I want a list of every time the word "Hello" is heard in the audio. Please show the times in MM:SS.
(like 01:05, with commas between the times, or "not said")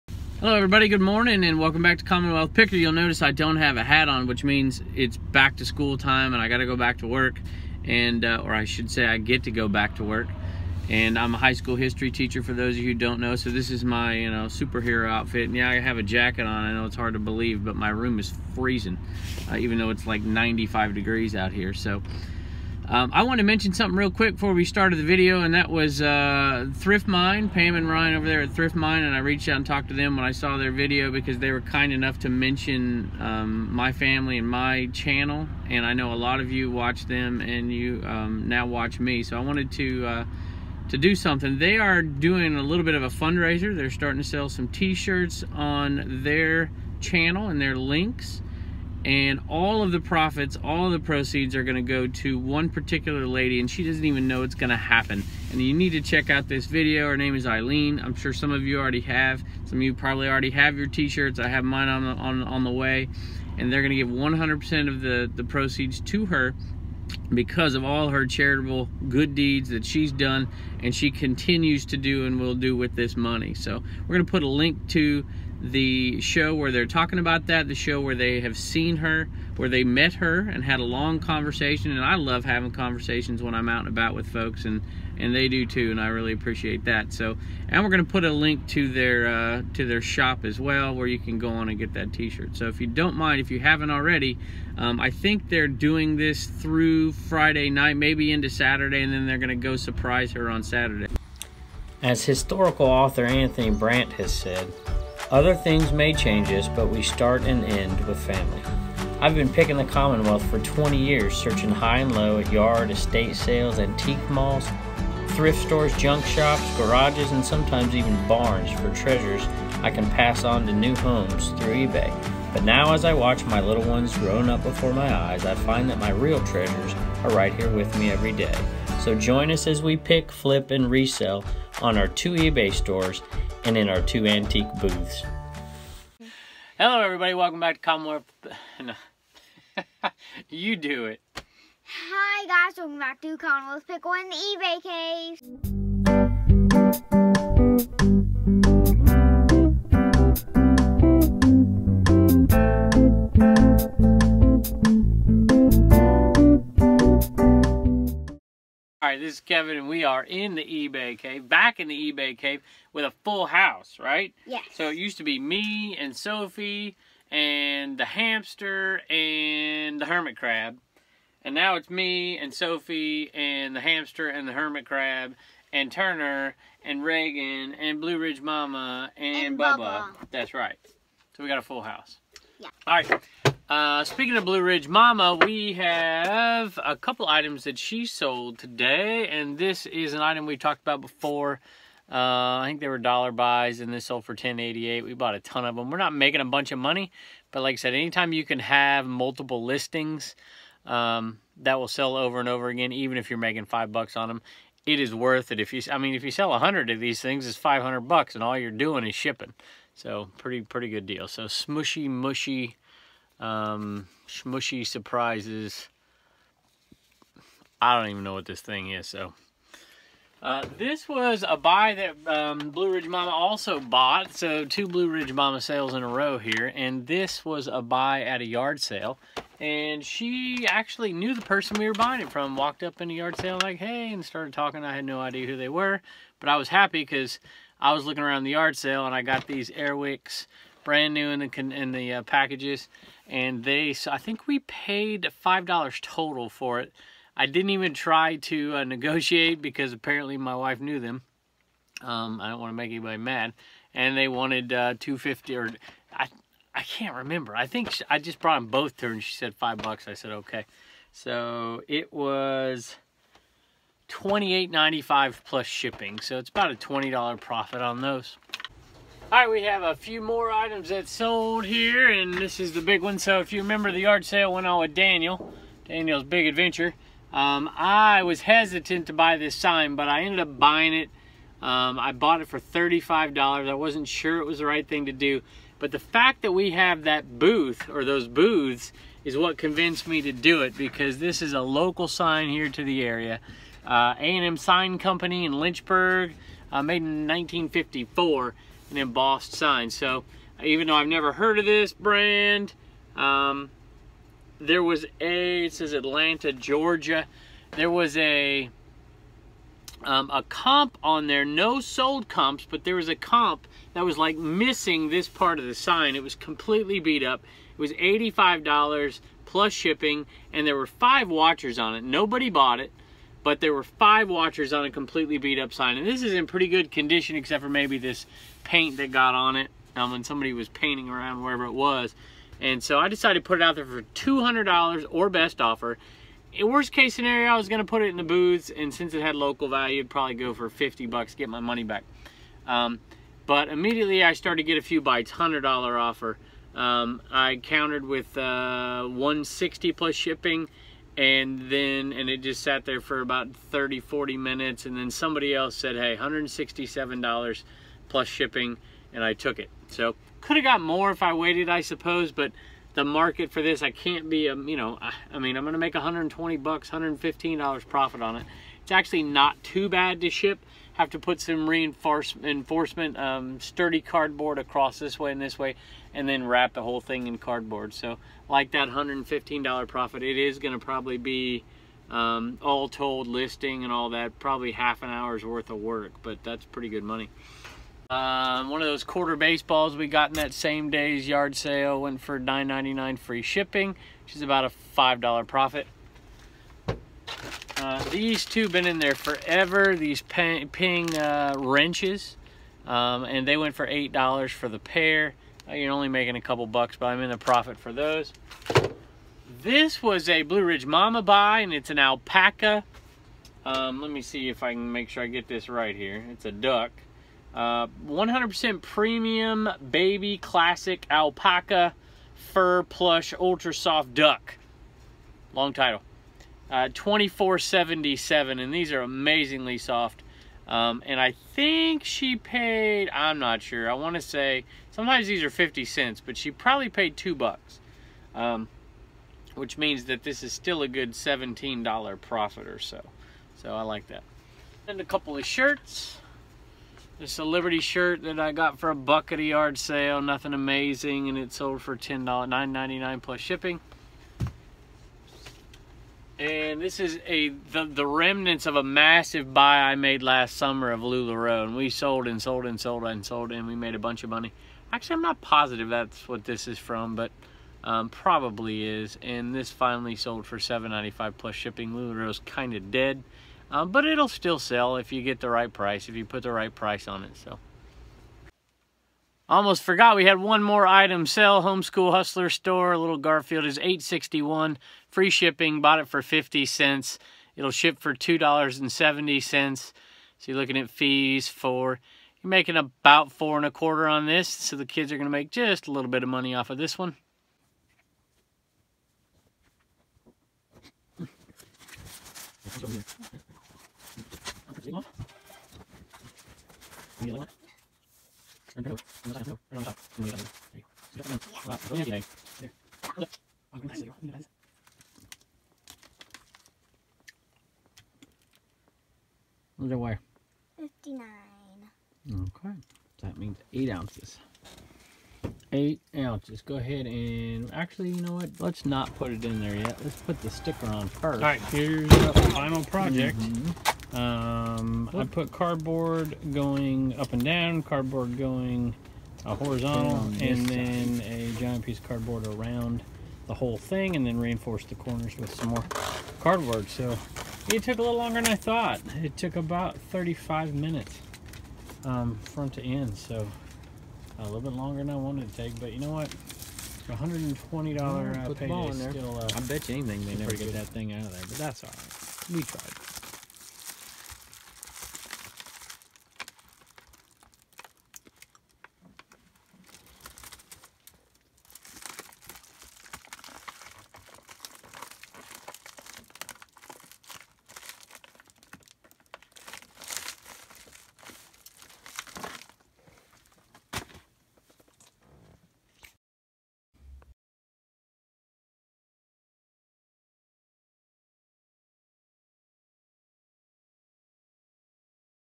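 00:00, 02:16.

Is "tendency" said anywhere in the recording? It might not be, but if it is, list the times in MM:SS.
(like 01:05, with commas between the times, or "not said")
not said.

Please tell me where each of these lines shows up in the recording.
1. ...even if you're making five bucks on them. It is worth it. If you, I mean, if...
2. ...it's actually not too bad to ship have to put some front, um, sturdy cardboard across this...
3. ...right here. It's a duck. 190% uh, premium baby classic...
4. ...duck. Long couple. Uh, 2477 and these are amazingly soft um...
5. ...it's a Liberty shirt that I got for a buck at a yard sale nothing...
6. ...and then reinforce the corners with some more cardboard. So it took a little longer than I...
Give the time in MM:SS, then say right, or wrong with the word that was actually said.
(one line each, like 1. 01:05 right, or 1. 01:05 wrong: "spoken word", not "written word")
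1. 03:22 right
2. 06:08 wrong: "reinforcement", not "front"
3. 06:55 wrong: "100", not "190"
4. 07:04 wrong: "title", not "couple"
5. 07:27 right
6. 09:04 right.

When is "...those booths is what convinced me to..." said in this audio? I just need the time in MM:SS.
04:48.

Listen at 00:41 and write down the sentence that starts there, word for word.
They are doing a little bit of a fundraiser.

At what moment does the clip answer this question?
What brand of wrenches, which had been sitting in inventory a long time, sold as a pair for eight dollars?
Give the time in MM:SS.
06:40.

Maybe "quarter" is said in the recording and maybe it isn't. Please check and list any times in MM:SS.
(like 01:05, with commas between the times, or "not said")
06:29, 08:13.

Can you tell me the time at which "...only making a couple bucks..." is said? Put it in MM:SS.
06:45.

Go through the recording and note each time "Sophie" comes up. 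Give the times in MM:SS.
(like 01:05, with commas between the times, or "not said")
02:46, 02:52.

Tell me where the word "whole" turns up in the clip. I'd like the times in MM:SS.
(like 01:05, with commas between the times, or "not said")
06:16, 09:03.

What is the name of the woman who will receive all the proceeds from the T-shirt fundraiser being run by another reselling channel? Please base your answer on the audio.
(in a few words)
Eileen.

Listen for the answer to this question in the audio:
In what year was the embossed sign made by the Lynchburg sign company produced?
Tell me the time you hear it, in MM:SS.
04:57.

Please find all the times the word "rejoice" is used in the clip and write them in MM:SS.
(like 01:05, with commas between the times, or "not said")
not said.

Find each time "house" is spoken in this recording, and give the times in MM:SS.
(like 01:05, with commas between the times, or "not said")
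02:43, 03:01.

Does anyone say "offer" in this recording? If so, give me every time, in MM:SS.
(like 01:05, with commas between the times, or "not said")
05:35, 05:45.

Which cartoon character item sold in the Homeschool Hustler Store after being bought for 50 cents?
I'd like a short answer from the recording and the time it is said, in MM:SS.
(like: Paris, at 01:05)
Garfield, at 08:03.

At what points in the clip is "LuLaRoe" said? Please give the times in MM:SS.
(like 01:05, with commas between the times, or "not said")
07:41, 07:51.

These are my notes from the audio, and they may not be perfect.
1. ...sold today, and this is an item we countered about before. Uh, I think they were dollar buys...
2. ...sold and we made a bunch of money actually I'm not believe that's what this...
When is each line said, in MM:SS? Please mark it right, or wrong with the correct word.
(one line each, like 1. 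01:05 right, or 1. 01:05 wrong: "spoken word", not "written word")
1. 03:08 wrong: "talked", not "countered"
2. 07:43 wrong: "positive", not "believe".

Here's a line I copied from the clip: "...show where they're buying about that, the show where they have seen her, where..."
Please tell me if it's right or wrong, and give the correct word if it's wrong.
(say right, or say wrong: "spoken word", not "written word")
wrong: "talking", not "buying".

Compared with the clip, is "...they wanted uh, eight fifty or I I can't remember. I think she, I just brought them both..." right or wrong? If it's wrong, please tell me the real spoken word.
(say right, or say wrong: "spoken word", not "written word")
wrong: "two", not "eight".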